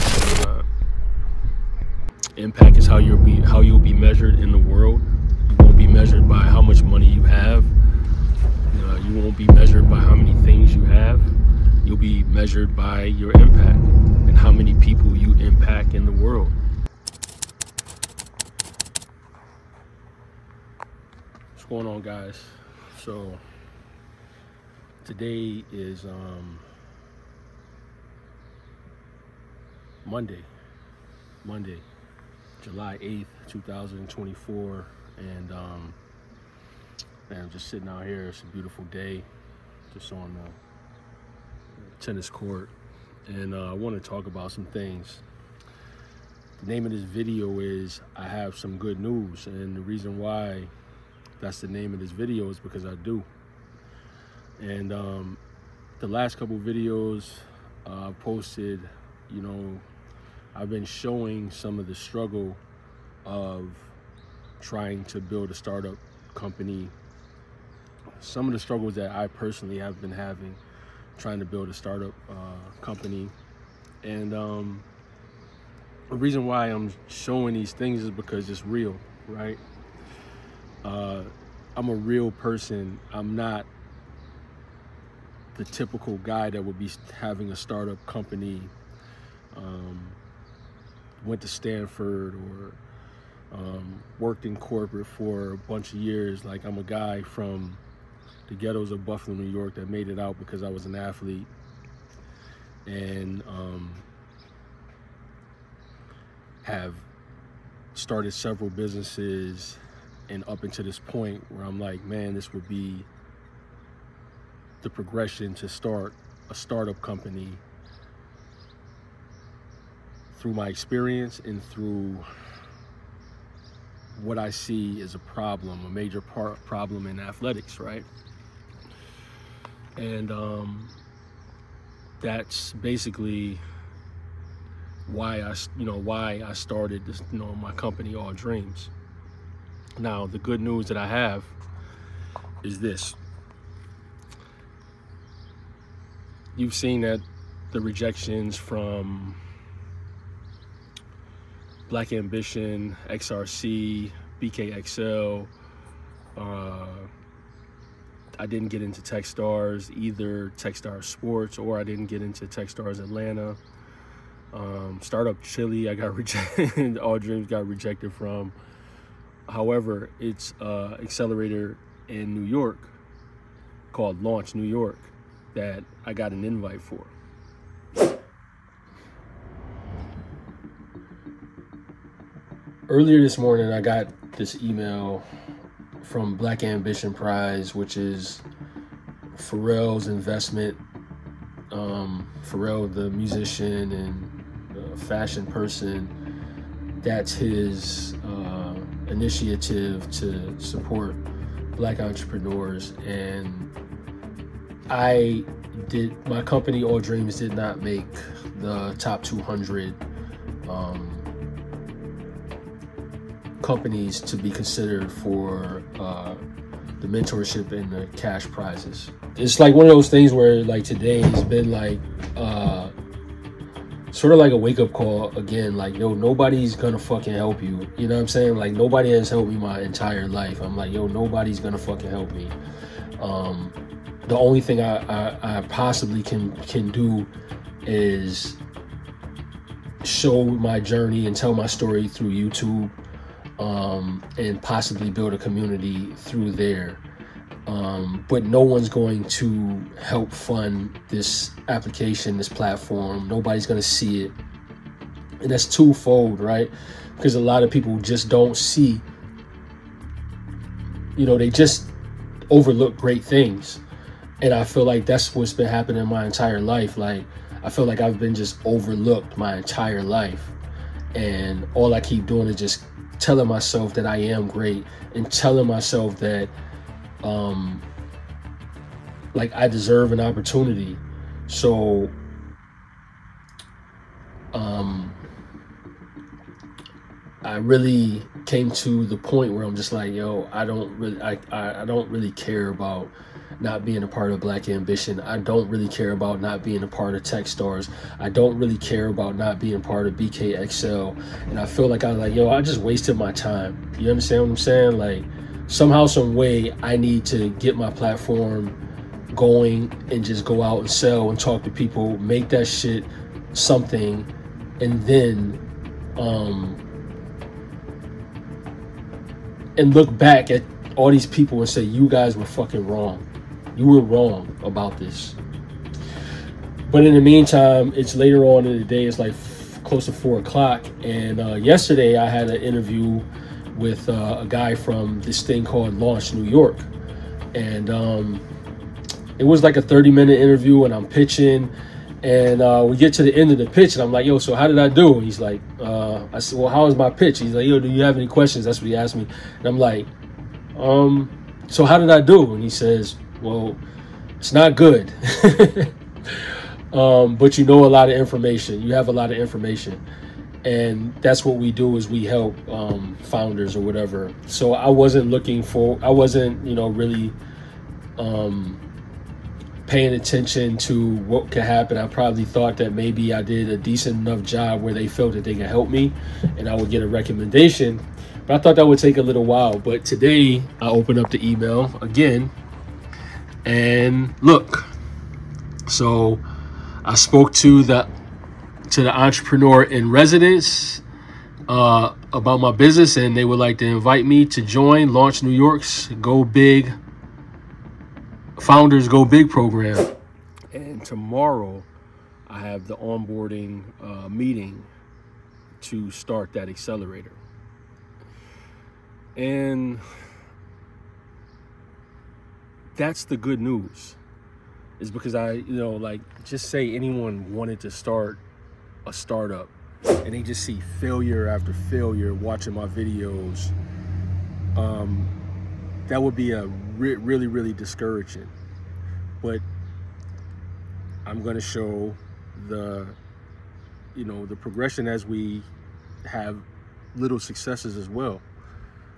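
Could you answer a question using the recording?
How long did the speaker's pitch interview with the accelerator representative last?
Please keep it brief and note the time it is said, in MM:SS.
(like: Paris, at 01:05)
30 minutes, at 05:39.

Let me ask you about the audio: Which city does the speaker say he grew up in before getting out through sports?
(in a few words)
Buffalo, New York.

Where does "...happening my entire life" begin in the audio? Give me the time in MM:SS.
04:25.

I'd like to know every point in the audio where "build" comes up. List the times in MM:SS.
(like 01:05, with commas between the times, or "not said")
01:05, 01:11, 04:05.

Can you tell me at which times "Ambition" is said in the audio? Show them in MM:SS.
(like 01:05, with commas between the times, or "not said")
02:32, 03:06, 04:54.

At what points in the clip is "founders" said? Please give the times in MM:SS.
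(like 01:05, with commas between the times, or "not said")
06:03, 06:38.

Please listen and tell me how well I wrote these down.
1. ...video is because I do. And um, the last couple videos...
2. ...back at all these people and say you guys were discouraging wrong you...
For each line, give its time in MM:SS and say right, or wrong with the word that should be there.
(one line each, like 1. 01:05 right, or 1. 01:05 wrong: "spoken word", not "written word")
1. 00:52 right
2. 05:20 wrong: "fucking", not "discouraging".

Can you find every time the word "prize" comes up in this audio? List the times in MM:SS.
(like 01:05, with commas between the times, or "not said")
03:07, 03:38.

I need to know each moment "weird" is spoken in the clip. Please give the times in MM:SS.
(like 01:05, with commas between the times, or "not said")
not said.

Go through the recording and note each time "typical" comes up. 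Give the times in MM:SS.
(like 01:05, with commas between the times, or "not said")
01:25.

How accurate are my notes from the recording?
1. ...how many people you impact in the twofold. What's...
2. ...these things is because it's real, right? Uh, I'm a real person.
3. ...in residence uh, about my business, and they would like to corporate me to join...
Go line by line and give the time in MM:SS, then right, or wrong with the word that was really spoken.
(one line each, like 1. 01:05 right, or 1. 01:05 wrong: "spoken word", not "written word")
1. 00:14 wrong: "world", not "twofold"
2. 01:17 right
3. 06:29 wrong: "invite", not "corporate".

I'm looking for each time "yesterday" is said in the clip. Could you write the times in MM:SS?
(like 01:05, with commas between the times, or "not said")
05:31.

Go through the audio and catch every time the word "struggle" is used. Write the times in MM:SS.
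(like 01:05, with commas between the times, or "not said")
01:01, 01:08.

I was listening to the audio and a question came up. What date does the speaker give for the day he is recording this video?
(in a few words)
July 8th, 2024.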